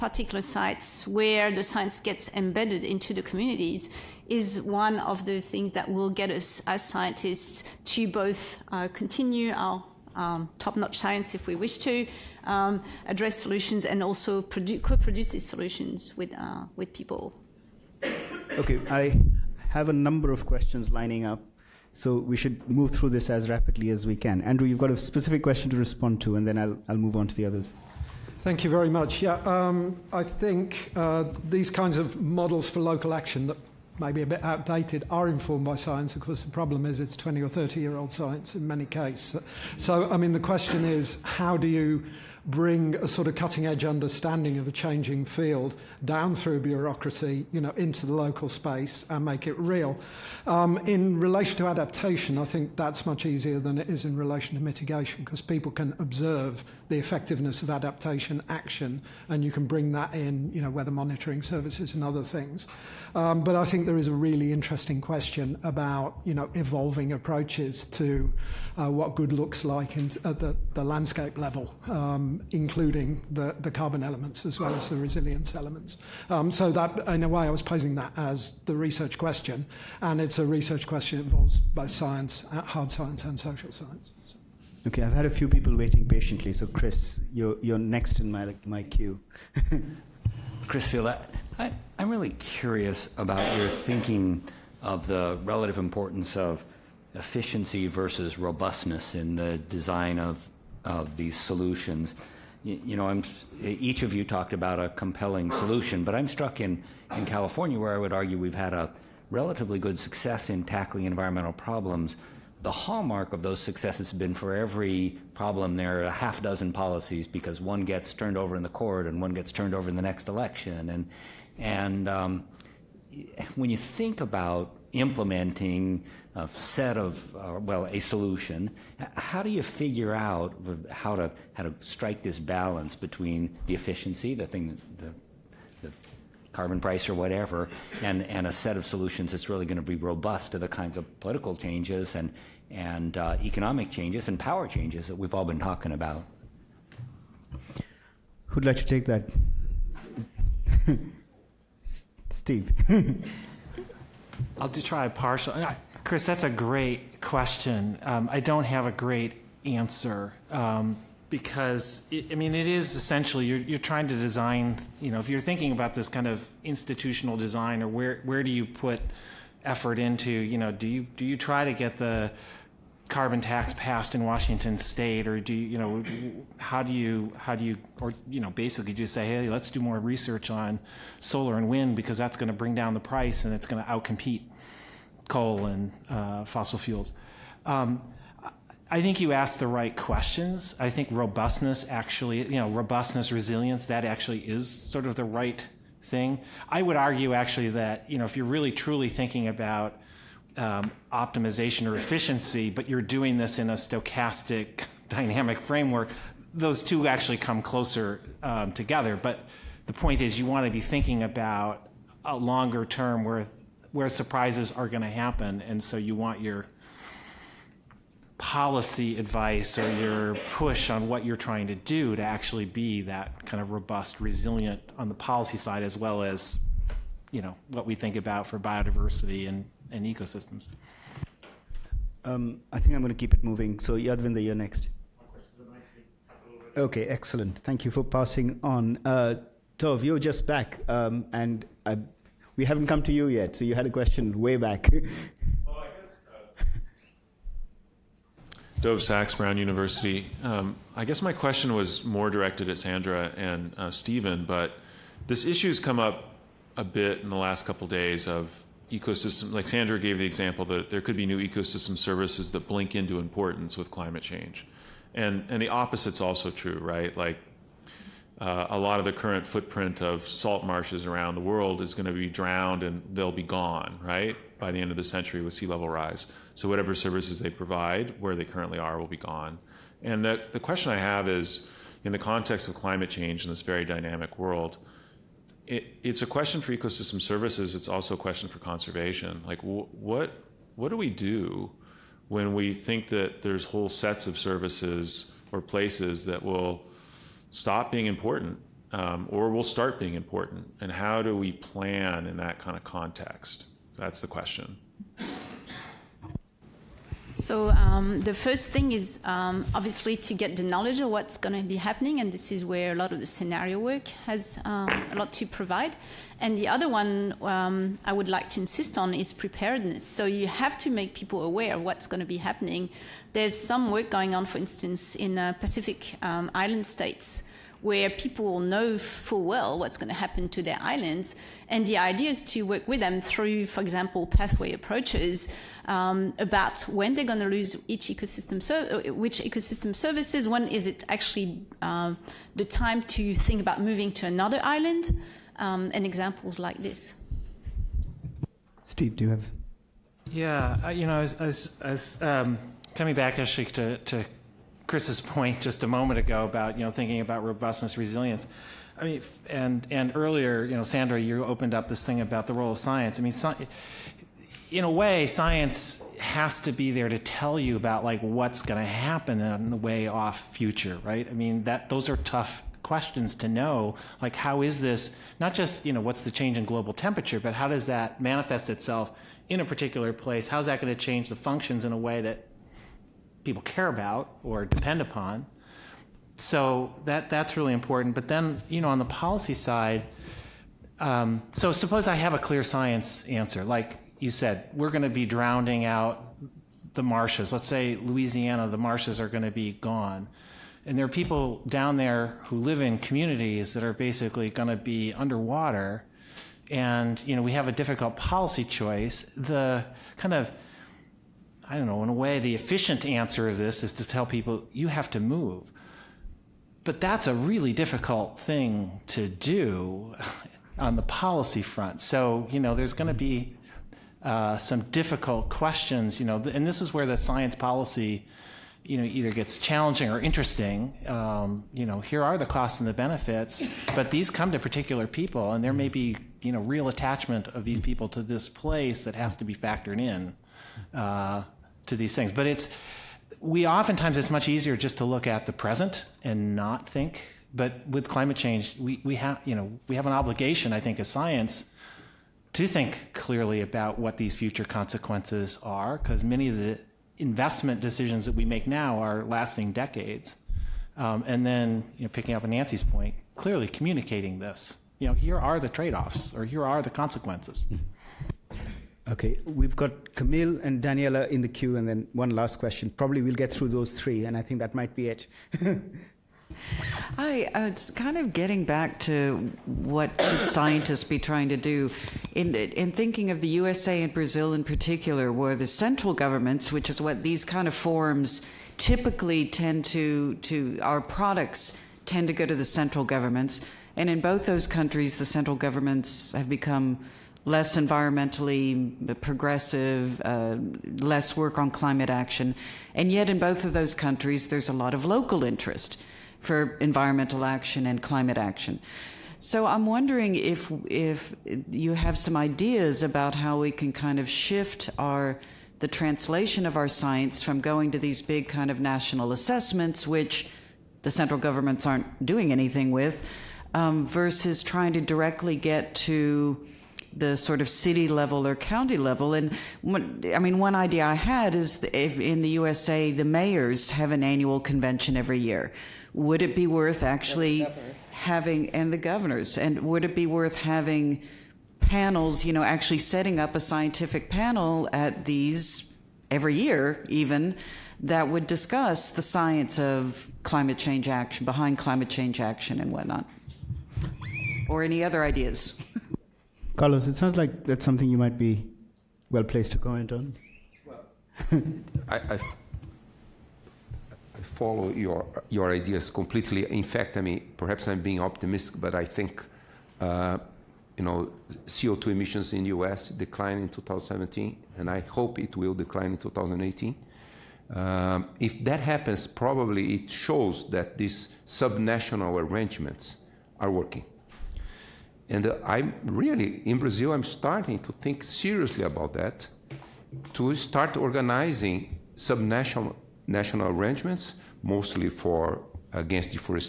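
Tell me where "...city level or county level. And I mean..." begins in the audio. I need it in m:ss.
8:47.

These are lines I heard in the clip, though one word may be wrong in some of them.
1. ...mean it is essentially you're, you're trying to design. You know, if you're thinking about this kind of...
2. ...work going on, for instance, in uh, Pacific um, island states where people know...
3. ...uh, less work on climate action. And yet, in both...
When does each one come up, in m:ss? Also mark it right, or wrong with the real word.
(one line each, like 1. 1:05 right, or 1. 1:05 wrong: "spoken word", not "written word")
1. 2:42 right
2. 5:23 right
3. 8:20 right.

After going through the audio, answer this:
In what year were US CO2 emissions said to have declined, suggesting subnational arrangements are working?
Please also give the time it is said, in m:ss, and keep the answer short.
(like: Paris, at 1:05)
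2017, at 9:33.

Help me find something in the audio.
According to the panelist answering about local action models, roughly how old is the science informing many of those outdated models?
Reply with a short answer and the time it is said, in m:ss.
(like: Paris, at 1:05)
20 or 30 years, at 0:37.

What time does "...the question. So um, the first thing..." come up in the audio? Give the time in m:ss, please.
5:04.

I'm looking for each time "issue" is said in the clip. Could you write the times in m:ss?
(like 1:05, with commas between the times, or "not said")
4:15.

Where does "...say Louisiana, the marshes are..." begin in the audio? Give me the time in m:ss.
6:37.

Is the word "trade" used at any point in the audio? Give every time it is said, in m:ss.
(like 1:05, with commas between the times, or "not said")
7:45.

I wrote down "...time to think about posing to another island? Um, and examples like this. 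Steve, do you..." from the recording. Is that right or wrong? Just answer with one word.
wrong.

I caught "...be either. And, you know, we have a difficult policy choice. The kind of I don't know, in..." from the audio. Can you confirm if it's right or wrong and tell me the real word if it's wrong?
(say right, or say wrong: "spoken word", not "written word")
wrong: "underwater", not "either".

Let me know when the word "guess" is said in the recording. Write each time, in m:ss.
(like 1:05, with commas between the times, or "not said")
4:11.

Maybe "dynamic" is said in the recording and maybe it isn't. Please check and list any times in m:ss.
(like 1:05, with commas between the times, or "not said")
3:25, 4:43.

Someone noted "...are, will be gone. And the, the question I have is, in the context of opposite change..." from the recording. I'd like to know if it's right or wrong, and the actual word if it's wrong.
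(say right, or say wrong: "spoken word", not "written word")
wrong: "climate", not "opposite".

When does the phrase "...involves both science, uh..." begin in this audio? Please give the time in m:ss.
1:21.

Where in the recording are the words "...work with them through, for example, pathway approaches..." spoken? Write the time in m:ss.
5:32.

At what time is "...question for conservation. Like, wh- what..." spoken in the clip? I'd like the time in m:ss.
4:48.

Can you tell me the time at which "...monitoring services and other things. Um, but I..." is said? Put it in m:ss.
1:00.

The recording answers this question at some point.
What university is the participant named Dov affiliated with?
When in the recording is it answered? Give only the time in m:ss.
4:09.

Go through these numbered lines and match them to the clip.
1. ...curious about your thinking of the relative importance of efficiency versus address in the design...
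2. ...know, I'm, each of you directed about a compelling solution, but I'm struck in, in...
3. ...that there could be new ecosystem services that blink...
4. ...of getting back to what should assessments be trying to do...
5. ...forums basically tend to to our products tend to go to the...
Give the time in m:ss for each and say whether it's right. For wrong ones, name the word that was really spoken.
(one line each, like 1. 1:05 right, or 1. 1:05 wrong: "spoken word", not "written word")
1. 1:32 wrong: "robustness", not "address"
2. 1:42 wrong: "talked", not "directed"
3. 4:20 right
4. 7:58 wrong: "scientists", not "assessments"
5. 8:07 wrong: "typically", not "basically".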